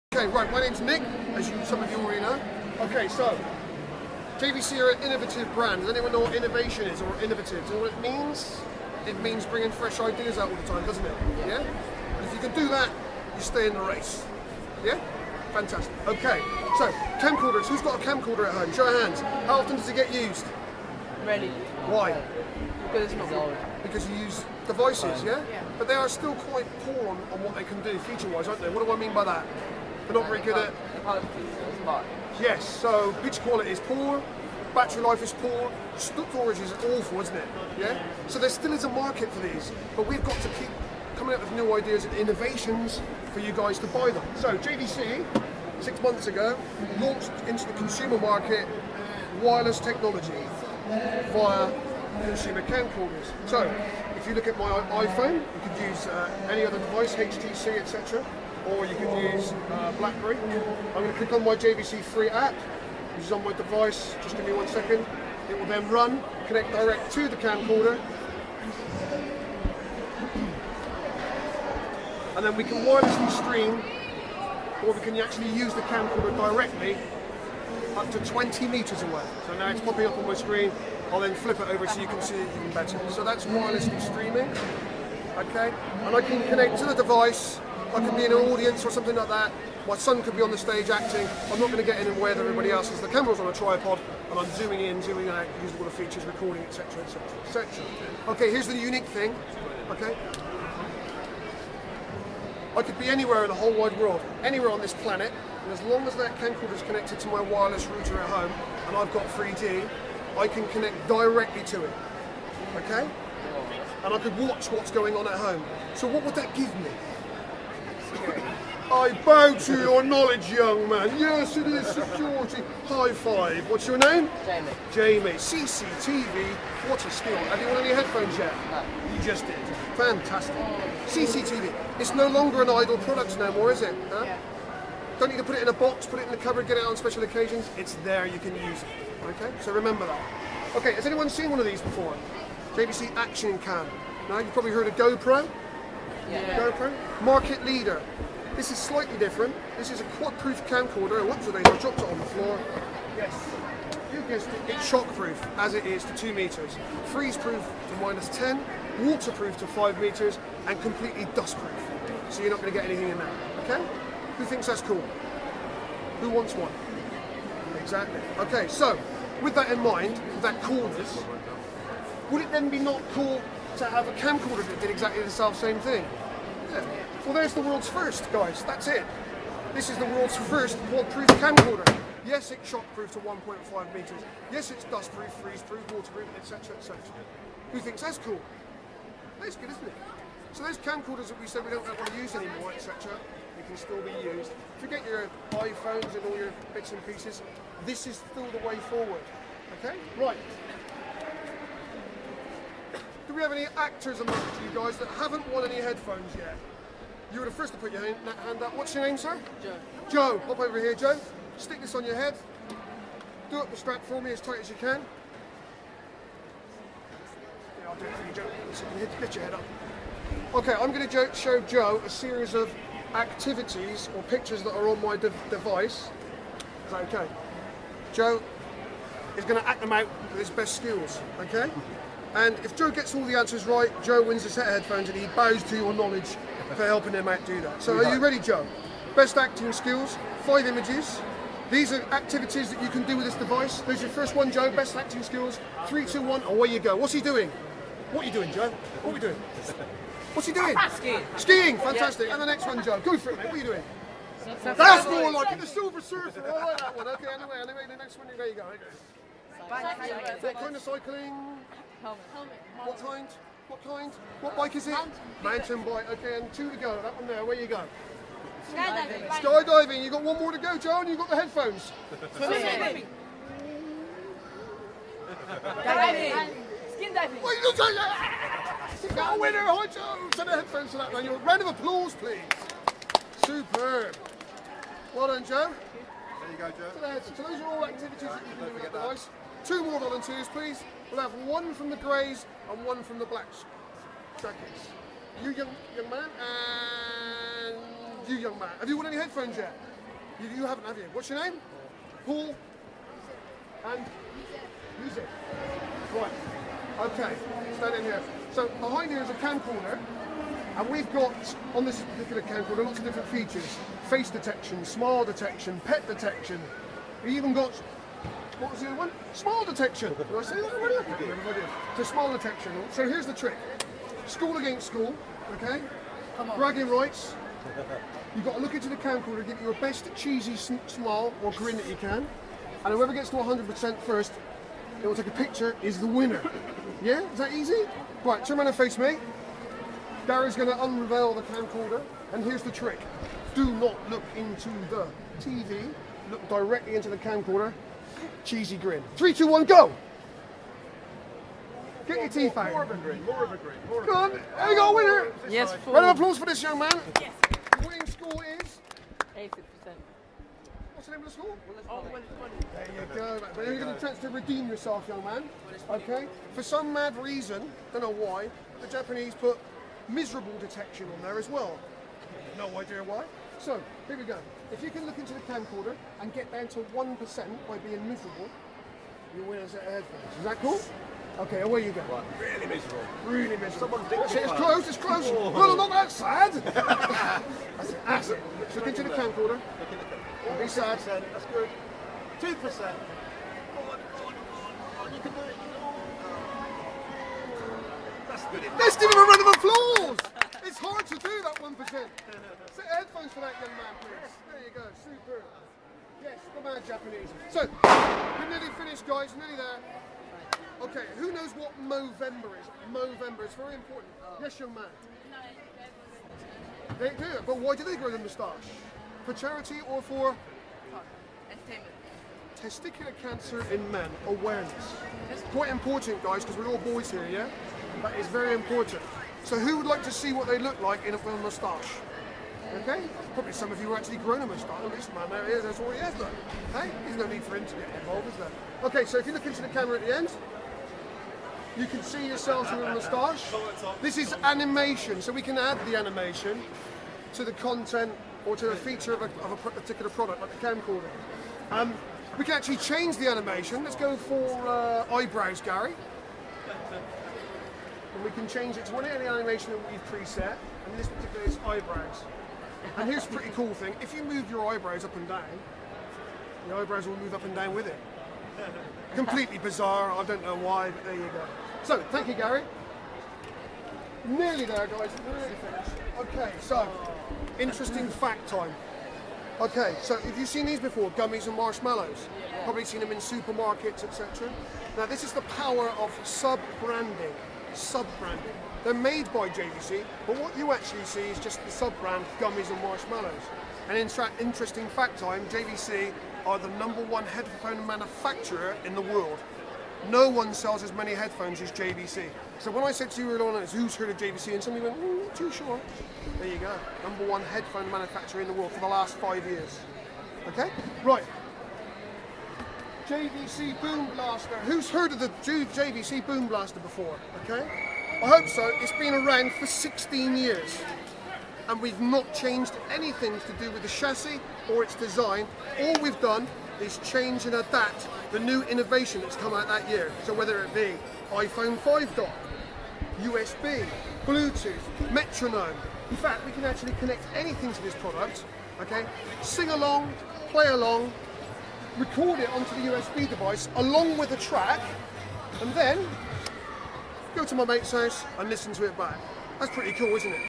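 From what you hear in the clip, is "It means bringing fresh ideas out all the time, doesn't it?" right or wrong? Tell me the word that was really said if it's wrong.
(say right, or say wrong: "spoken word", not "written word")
right.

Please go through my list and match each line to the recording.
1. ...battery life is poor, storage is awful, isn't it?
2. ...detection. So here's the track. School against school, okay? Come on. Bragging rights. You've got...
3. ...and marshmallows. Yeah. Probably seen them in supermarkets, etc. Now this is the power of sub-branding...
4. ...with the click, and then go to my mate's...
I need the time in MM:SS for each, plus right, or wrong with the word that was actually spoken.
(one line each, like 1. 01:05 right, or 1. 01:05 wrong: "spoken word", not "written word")
1. 00:34 right
2. 05:22 wrong: "trick", not "track"
3. 08:01 right
4. 09:04 wrong: "track", not "click".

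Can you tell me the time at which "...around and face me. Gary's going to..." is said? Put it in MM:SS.
05:38.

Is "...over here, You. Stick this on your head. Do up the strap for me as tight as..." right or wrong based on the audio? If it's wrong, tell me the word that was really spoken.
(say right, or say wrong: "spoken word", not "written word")
wrong: "Joe", not "You".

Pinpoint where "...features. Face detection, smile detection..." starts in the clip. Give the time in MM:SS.
05:13.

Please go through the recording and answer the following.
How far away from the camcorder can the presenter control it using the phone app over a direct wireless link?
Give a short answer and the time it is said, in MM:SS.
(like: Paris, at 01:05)
20 meters, at 01:18.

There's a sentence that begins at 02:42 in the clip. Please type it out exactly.
So you're not going to get anything in there, okay?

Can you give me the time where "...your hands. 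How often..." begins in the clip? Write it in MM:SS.
00:18.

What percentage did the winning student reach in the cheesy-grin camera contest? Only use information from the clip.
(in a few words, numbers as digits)
80%.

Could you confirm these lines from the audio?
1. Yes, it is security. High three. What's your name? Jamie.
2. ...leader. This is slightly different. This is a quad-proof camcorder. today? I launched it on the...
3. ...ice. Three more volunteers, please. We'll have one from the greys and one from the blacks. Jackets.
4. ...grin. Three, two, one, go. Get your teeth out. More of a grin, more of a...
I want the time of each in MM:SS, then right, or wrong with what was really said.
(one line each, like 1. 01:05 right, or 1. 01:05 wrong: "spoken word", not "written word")
1. 02:01 wrong: "five", not "three"
2. 02:27 wrong: "dropped", not "launched"
3. 04:48 wrong: "Two", not "Three"
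4. 05:48 right.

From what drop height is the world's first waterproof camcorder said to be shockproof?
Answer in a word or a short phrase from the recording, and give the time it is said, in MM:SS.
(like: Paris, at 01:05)
1.5 meters, at 03:03.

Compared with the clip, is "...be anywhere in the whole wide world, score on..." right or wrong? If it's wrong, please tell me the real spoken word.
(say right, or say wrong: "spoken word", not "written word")
wrong: "anywhere", not "score".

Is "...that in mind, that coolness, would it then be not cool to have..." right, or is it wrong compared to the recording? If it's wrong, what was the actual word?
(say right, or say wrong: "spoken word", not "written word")
right.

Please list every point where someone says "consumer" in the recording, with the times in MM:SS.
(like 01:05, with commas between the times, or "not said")
00:47, 00:52.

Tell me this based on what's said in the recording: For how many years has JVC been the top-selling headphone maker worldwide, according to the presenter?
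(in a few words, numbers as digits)
5 years.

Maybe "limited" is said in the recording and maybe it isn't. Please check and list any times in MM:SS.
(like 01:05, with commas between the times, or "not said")
not said.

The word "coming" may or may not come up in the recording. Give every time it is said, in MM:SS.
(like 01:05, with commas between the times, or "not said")
00:41.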